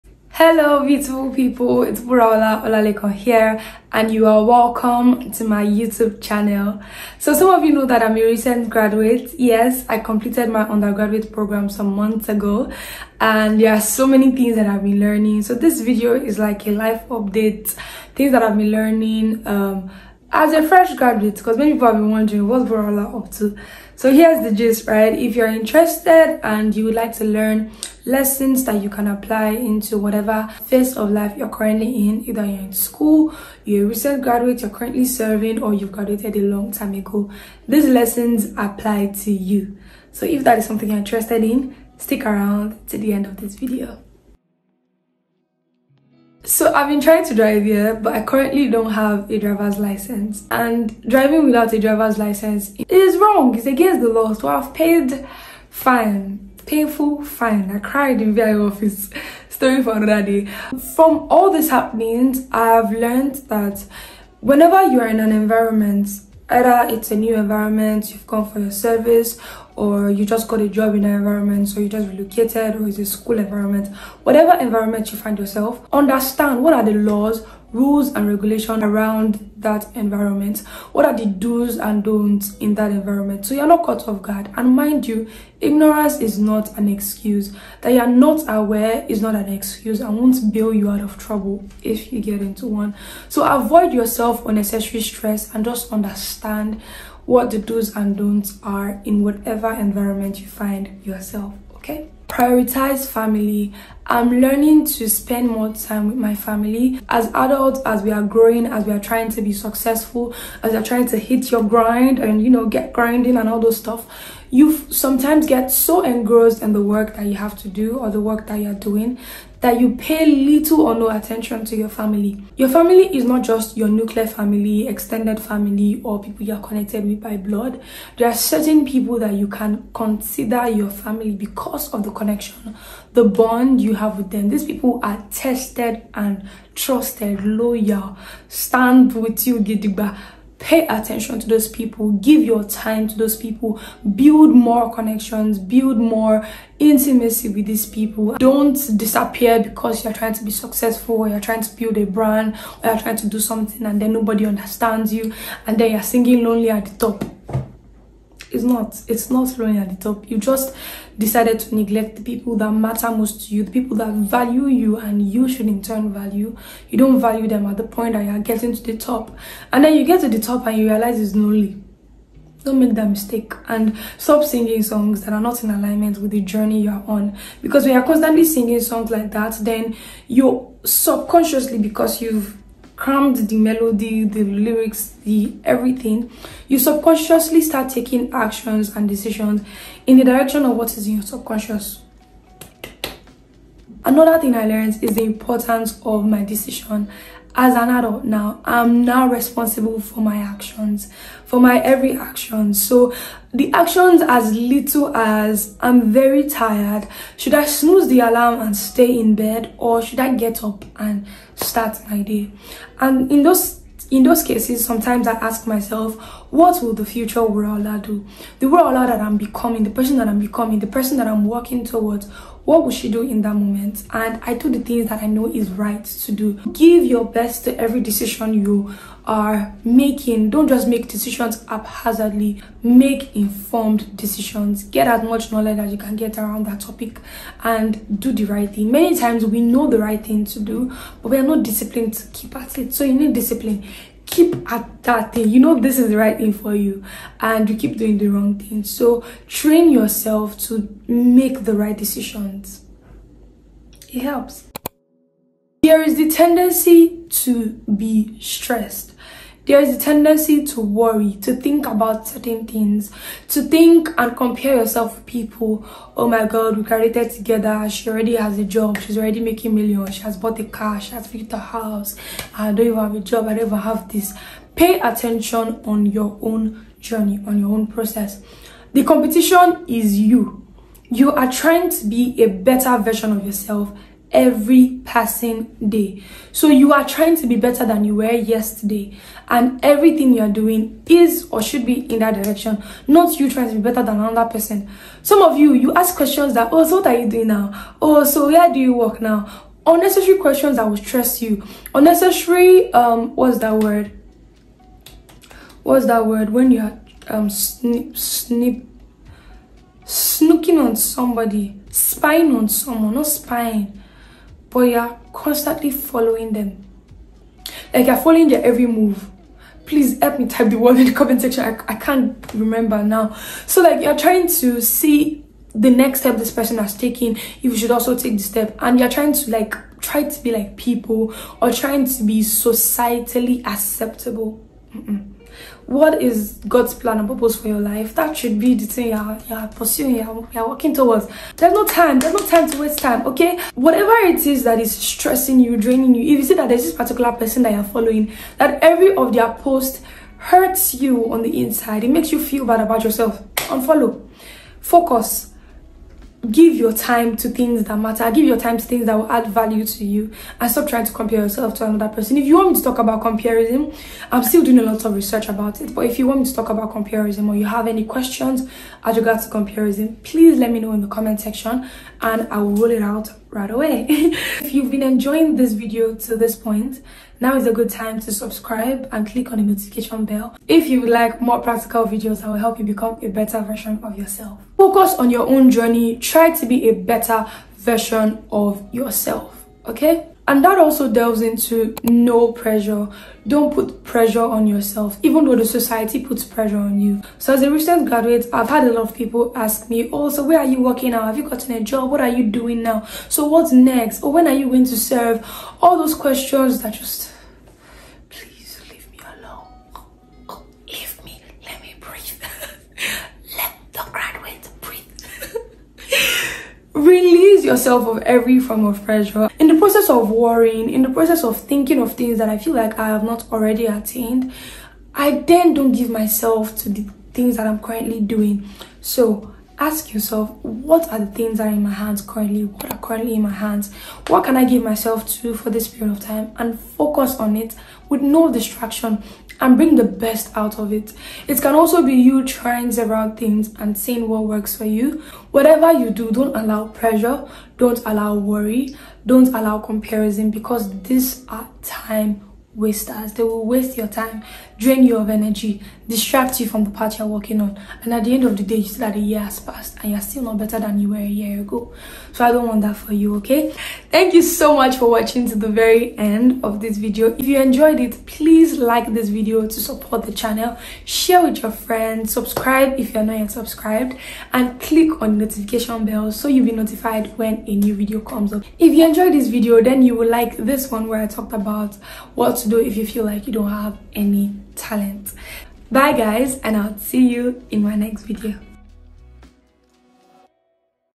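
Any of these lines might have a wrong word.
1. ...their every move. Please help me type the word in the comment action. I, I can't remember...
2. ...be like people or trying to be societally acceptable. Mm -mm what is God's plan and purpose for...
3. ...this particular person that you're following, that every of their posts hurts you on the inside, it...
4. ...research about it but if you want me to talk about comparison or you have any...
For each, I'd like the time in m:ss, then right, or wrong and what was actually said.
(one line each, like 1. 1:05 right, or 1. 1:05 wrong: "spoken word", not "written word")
1. 5:18 wrong: "section", not "action"
2. 5:30 right
3. 5:46 right
4. 6:05 right.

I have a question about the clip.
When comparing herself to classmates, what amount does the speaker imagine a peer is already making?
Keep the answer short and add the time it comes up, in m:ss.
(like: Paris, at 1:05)
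Millions, at 4:29.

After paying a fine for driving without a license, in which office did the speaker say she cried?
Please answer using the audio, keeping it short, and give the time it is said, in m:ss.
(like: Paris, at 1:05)
VI office, at 0:58.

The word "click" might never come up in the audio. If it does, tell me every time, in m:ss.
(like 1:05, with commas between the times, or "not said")
6:19, 7:54.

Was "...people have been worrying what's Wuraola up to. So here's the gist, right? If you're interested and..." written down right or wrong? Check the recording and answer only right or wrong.
wrong.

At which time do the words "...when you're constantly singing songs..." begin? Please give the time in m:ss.
2:57.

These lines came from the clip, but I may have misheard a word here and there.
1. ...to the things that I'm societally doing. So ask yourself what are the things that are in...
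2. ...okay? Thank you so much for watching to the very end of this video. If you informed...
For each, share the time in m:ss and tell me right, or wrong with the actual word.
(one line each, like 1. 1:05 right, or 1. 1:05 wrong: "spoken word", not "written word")
1. 7:06 wrong: "currently", not "societally"
2. 7:43 wrong: "enjoyed", not "informed".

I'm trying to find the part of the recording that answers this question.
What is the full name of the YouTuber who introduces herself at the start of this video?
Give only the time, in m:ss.
0:02.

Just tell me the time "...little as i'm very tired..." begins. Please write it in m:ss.
3:24.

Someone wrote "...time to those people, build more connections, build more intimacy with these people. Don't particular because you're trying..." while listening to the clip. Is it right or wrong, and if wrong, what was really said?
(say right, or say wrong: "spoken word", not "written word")
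wrong: "disappear", not "particular".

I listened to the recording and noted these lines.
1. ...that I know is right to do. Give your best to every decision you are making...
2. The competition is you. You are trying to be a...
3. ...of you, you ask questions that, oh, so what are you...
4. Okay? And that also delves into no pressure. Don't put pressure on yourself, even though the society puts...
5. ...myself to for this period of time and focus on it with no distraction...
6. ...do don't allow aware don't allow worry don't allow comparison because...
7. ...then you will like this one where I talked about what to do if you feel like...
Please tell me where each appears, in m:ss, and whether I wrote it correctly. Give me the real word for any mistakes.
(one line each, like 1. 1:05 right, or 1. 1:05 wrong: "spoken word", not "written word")
1. 3:45 right
2. 4:38 right
3. 4:55 right
4. 6:29 right
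5. 7:14 right
6. 7:26 wrong: "pressure", not "aware"
7. 7:59 right.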